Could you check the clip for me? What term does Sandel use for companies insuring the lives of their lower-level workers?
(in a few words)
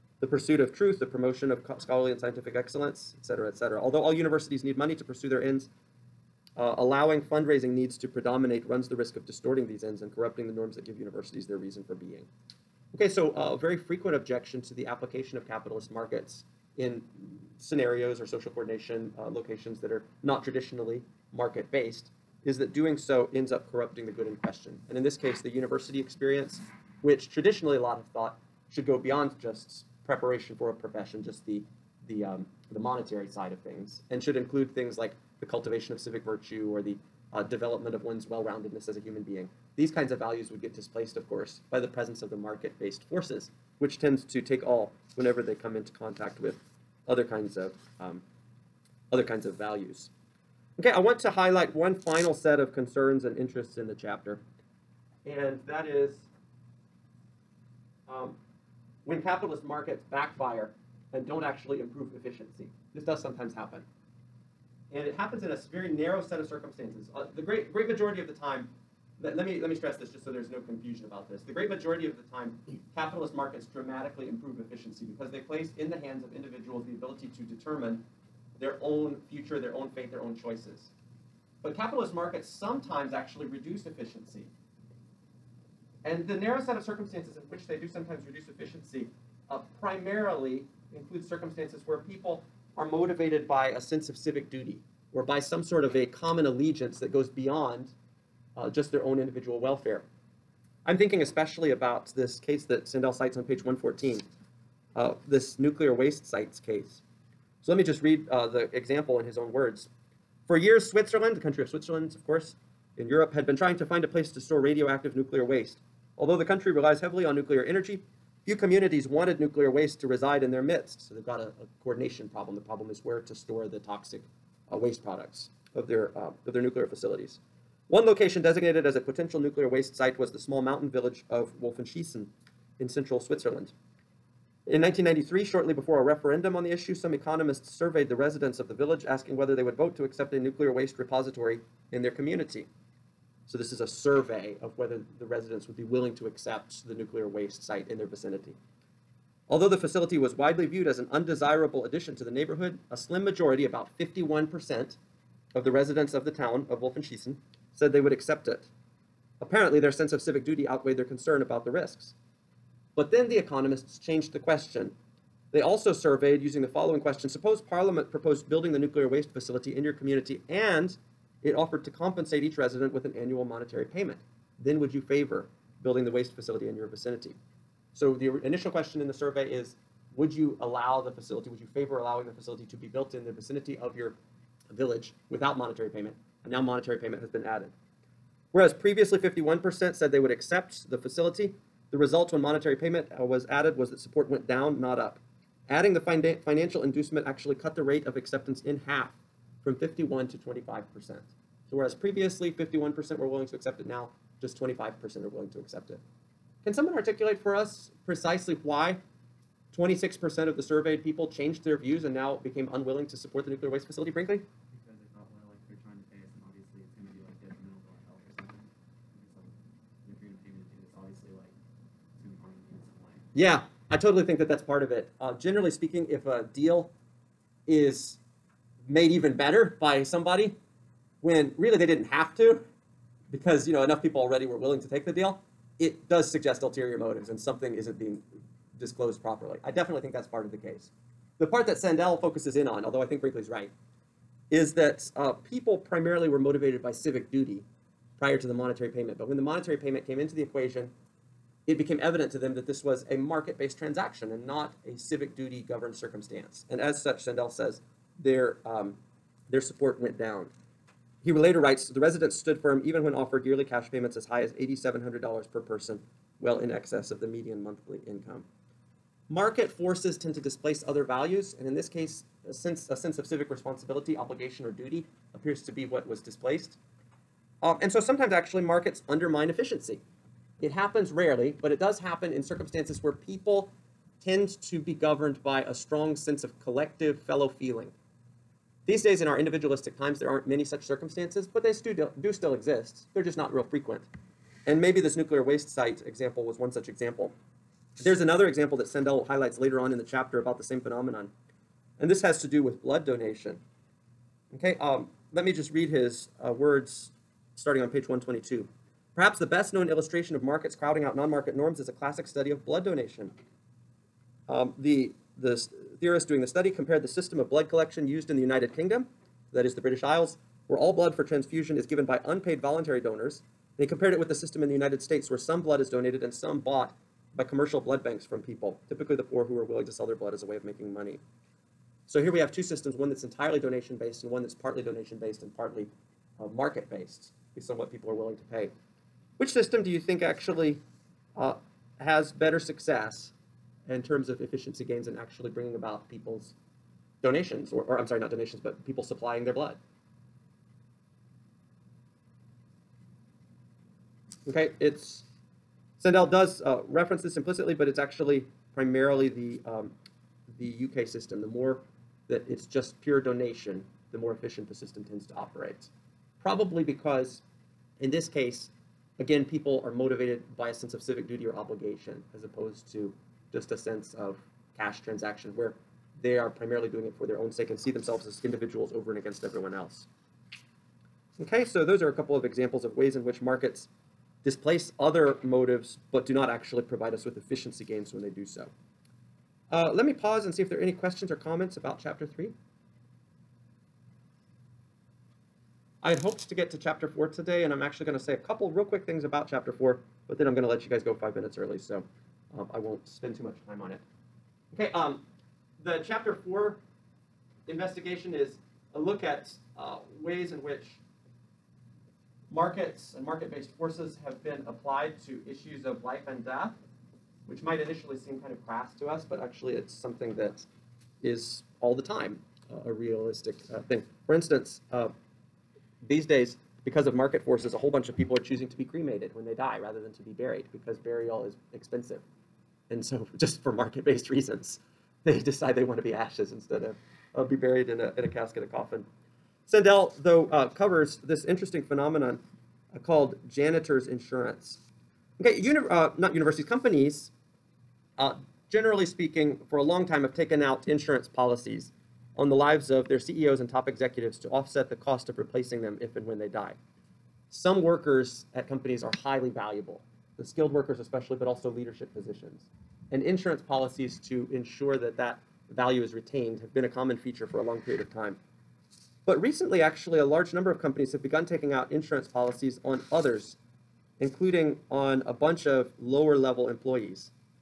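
janitor's insurance.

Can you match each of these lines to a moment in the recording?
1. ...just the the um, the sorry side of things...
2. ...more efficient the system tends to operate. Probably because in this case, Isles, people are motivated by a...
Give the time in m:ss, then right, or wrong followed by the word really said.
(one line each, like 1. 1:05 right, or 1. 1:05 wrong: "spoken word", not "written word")
1. 0:31 wrong: "monetary", not "sorry"
2. 6:04 wrong: "Again", not "Isles".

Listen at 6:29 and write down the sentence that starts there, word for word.
Uh, let me pause and see if there are any questions or comments about chapter 3.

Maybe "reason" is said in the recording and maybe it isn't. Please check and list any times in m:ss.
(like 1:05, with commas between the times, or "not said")
0:11, 7:14.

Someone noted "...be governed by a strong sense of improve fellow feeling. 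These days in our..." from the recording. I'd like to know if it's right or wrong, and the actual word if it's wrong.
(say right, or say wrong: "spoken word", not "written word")
wrong: "collective", not "improve".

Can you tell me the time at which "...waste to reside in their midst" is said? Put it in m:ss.
1:59.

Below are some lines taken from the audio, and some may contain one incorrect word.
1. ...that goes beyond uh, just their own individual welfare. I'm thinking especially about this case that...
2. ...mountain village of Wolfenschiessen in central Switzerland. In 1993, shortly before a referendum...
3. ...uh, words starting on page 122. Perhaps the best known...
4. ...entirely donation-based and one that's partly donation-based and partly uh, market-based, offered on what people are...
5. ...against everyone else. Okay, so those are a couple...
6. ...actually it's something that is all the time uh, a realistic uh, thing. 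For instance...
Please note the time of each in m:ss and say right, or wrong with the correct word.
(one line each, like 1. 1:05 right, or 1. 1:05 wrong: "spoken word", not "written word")
1. 1:36 right
2. 2:10 right
3. 5:06 right
4. 5:33 wrong: "based", not "offered"
5. 6:19 right
6. 6:59 right.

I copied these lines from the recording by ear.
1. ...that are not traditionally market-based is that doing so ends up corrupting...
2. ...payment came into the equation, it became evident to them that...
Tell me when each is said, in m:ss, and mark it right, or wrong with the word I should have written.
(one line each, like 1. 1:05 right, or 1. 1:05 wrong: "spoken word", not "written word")
1. 0:19 right
2. 4:09 right.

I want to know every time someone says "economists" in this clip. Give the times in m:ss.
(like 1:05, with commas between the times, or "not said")
2:17, 2:43.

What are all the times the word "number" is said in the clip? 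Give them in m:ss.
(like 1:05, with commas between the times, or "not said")
7:50.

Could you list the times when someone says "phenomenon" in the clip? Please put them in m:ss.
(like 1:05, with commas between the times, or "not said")
5:00, 7:21.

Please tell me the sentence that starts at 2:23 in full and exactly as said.
So this is a survey of whether the residents would be willing to accept the nuclear waste site in their vicinity.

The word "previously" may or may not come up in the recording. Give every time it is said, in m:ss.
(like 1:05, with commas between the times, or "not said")
3:08, 3:21.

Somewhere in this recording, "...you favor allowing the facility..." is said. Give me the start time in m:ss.
3:01.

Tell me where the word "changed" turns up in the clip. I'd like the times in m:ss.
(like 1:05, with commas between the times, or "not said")
2:43, 3:31.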